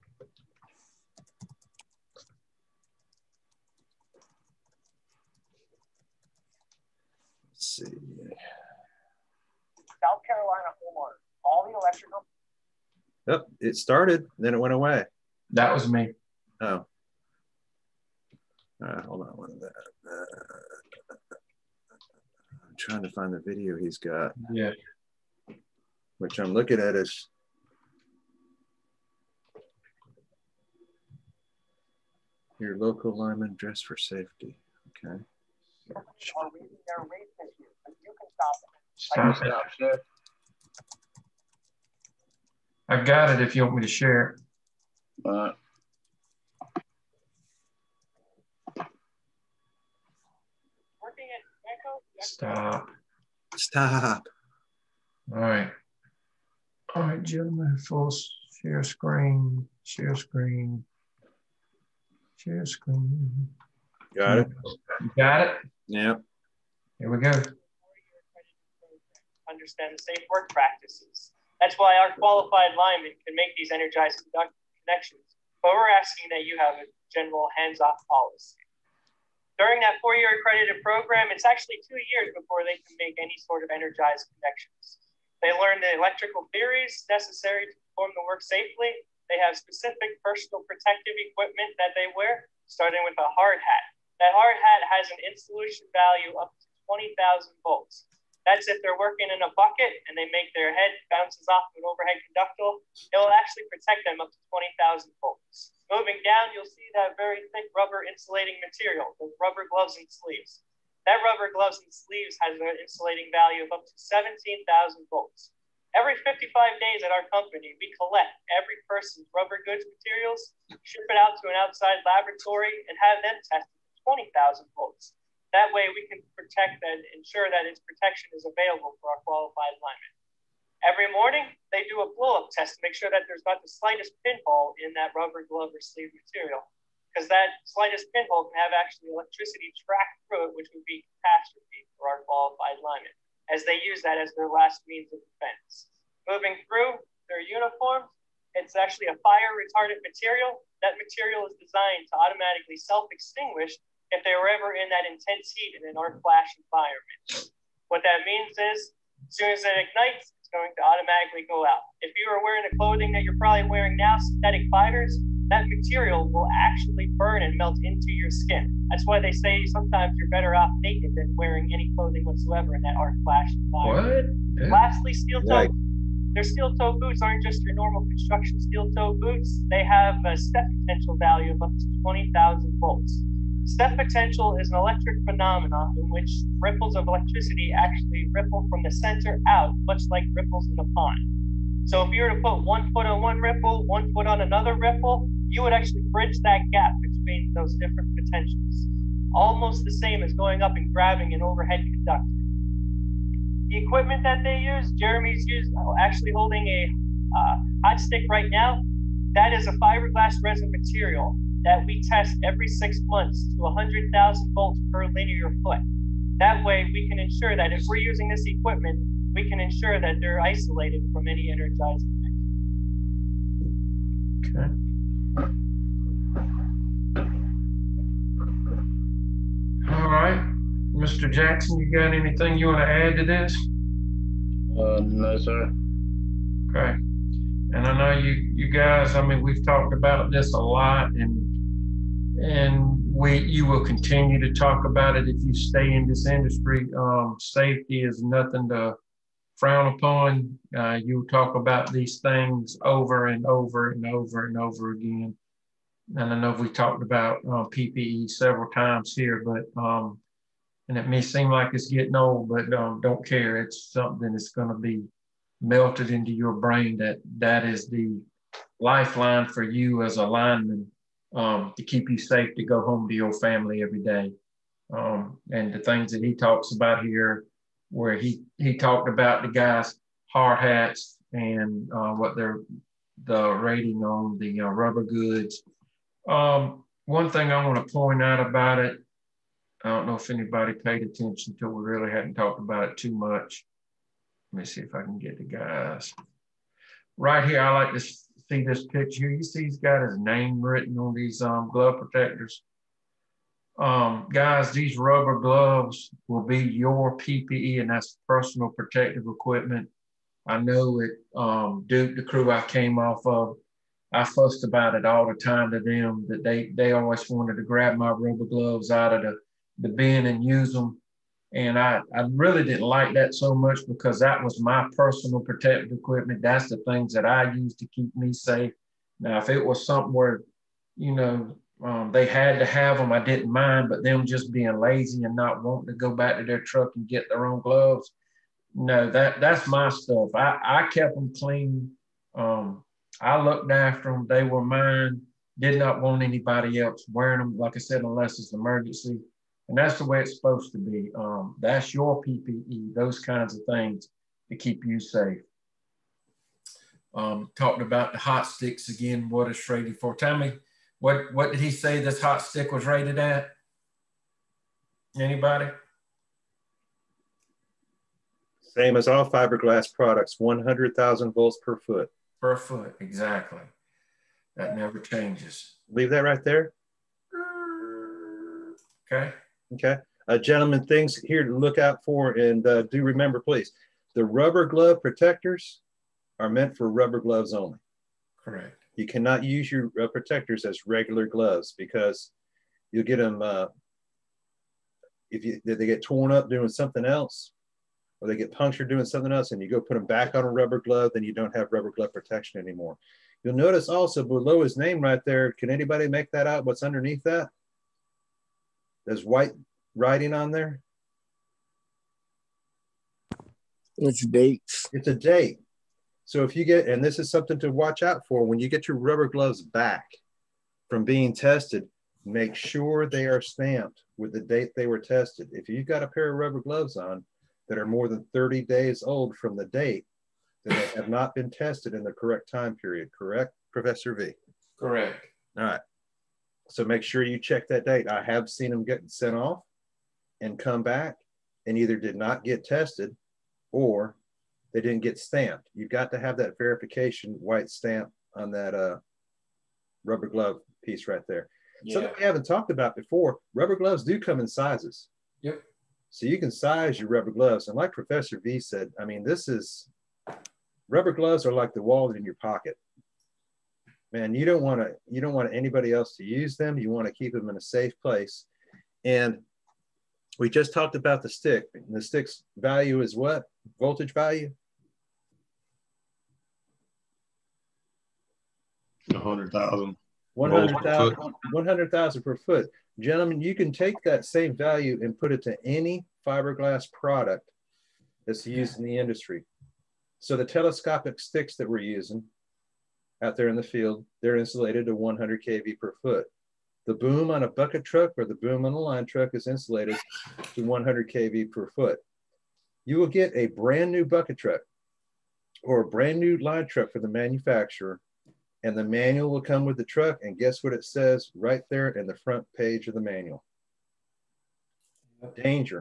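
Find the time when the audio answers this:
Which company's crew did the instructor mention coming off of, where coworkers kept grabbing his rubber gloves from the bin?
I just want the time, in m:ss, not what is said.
5:11.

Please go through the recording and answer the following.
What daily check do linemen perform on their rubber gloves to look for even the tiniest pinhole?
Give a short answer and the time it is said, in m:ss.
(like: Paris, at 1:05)
blow-up test, at 2:12.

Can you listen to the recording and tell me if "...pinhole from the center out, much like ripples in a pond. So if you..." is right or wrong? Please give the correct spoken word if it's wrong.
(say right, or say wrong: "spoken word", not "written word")
wrong: "ripple", not "pinhole".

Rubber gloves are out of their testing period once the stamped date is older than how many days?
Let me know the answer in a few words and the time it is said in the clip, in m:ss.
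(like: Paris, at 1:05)
30 days, at 7:08.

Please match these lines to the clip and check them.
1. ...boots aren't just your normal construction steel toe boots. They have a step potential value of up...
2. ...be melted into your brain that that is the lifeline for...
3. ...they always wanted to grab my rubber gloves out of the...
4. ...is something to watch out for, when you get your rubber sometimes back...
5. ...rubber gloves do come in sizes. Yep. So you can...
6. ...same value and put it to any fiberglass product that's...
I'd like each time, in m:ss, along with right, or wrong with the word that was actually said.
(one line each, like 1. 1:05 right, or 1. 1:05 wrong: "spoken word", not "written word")
1. 2:56 right
2. 4:24 right
3. 5:16 right
4. 6:57 wrong: "gloves", not "sometimes"
5. 7:33 right
6. 8:04 right.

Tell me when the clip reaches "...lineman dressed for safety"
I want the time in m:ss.
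0:33.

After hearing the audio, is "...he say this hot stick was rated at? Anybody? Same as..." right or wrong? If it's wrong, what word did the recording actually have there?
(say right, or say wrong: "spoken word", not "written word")
right.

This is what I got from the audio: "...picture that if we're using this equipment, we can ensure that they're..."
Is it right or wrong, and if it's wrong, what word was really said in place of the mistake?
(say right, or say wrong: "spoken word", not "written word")
wrong: "ensure", not "picture".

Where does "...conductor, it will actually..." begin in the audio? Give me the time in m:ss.
1:42.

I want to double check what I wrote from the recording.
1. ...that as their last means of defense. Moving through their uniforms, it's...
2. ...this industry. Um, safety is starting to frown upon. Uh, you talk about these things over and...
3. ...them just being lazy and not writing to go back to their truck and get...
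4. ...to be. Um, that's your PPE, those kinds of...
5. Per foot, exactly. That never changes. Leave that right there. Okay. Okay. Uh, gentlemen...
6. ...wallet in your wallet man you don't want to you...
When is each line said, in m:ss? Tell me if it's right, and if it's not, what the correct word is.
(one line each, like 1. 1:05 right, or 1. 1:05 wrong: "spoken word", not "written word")
1. 2:24 right
2. 4:06 wrong: "nothing", not "starting"
3. 5:34 wrong: "wanting", not "writing"
4. 5:50 right
5. 6:12 right
6. 7:41 wrong: "pocket", not "wallet".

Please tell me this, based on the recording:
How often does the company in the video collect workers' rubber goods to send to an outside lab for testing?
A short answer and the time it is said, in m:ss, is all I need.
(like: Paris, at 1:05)
Every 55 days, at 1:55.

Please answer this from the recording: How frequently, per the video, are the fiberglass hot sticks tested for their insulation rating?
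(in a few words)
every six months.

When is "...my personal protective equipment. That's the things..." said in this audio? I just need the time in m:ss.
5:24.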